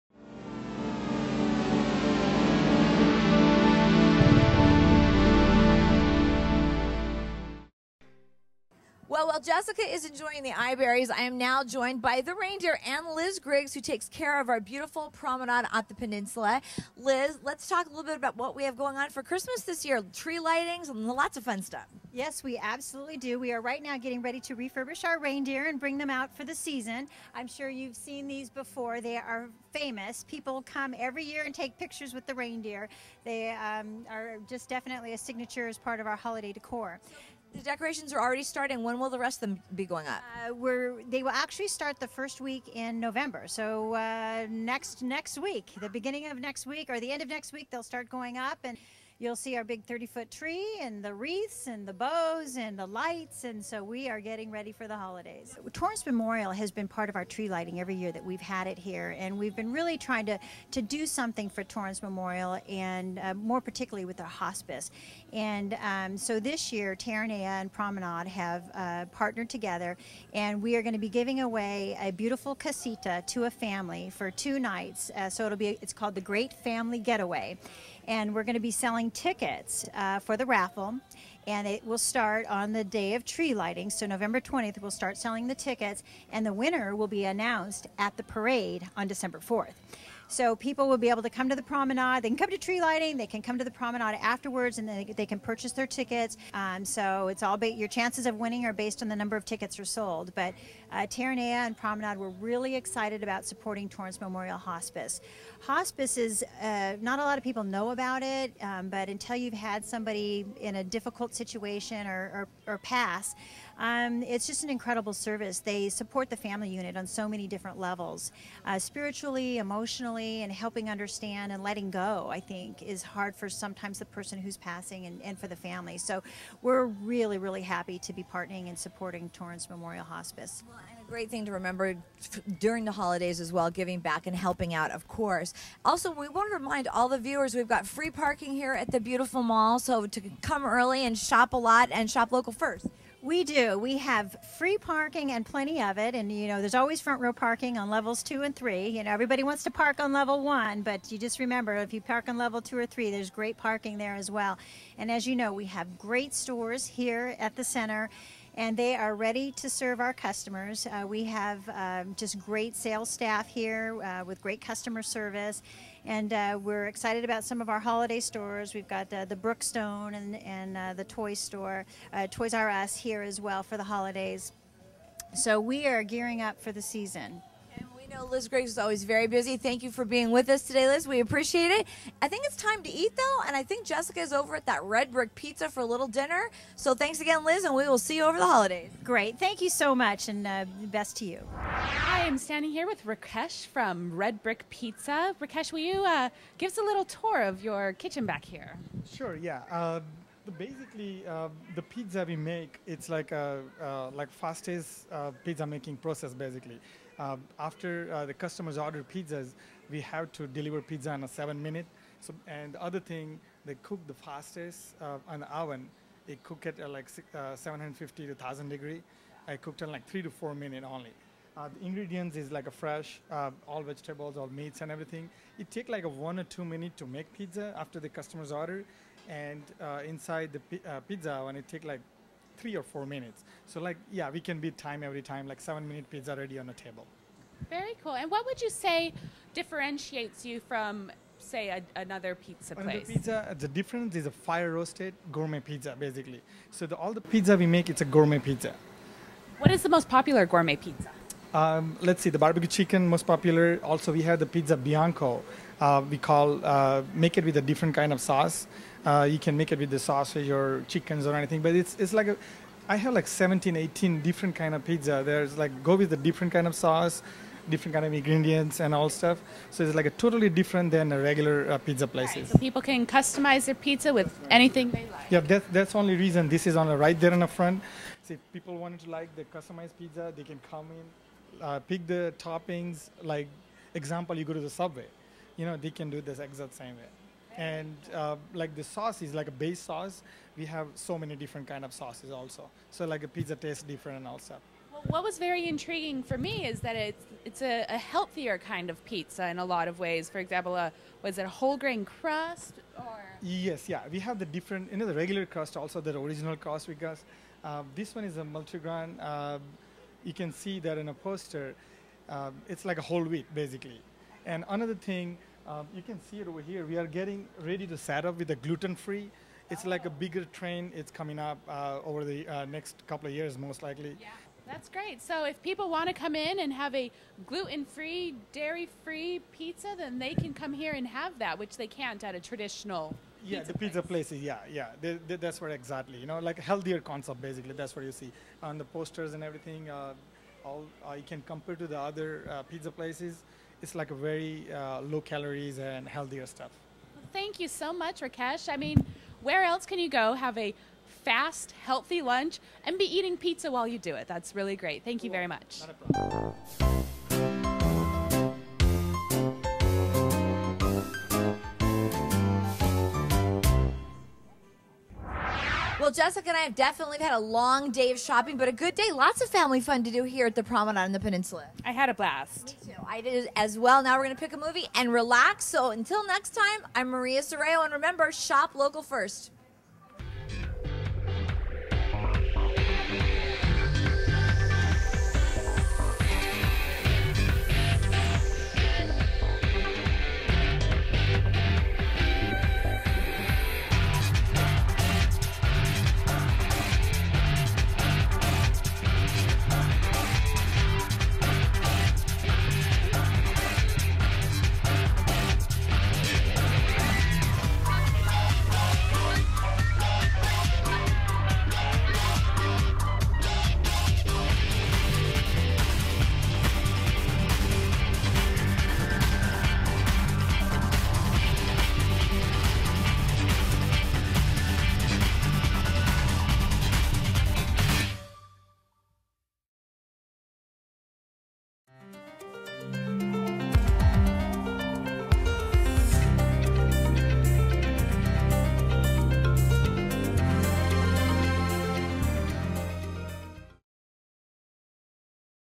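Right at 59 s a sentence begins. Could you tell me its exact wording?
And we've been really trying to, to do something for Torrance Memorial and uh, more particularly with our hospice.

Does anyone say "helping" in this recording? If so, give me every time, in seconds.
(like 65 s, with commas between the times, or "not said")
120 s, 134 s.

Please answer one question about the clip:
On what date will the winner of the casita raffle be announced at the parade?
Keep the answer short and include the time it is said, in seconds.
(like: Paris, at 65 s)
December 4th, at 89 s.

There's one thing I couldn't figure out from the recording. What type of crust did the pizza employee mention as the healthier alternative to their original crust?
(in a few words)
Multigrain.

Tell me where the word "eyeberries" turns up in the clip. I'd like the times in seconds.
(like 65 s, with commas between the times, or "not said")
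10 s.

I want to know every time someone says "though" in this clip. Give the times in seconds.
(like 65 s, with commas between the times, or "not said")
183 s.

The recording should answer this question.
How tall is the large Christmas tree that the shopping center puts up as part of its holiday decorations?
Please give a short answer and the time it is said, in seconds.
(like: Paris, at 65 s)
30 feet, at 49 s.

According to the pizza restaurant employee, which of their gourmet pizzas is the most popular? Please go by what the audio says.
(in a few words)
Barbecue chicken.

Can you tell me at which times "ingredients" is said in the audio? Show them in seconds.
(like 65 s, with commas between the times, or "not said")
221 s, 268 s.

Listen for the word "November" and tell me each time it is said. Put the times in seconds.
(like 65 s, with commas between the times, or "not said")
42 s, 84 s.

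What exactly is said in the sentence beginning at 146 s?
And, you know, there's always front row parking on levels two and three.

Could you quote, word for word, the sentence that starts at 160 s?
Uh, we have um, just great sales staff here uh, with great customer service.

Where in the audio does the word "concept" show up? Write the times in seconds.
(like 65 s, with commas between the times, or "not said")
336 s.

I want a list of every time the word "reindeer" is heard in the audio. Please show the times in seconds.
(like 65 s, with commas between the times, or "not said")
12 s, 25 s, 32 s.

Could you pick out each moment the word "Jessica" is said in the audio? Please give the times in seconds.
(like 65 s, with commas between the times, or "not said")
9 s, 183 s, 366 s.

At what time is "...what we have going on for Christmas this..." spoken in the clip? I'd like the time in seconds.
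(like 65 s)
18 s.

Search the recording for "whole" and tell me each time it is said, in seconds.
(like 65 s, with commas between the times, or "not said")
301 s, 313 s.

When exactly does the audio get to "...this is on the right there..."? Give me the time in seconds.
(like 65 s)
276 s.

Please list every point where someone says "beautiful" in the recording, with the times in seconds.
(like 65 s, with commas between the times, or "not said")
14 s, 72 s, 138 s.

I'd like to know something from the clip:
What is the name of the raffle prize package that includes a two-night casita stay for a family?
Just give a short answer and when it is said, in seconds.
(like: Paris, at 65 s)
Great Family Getaway, at 76 s.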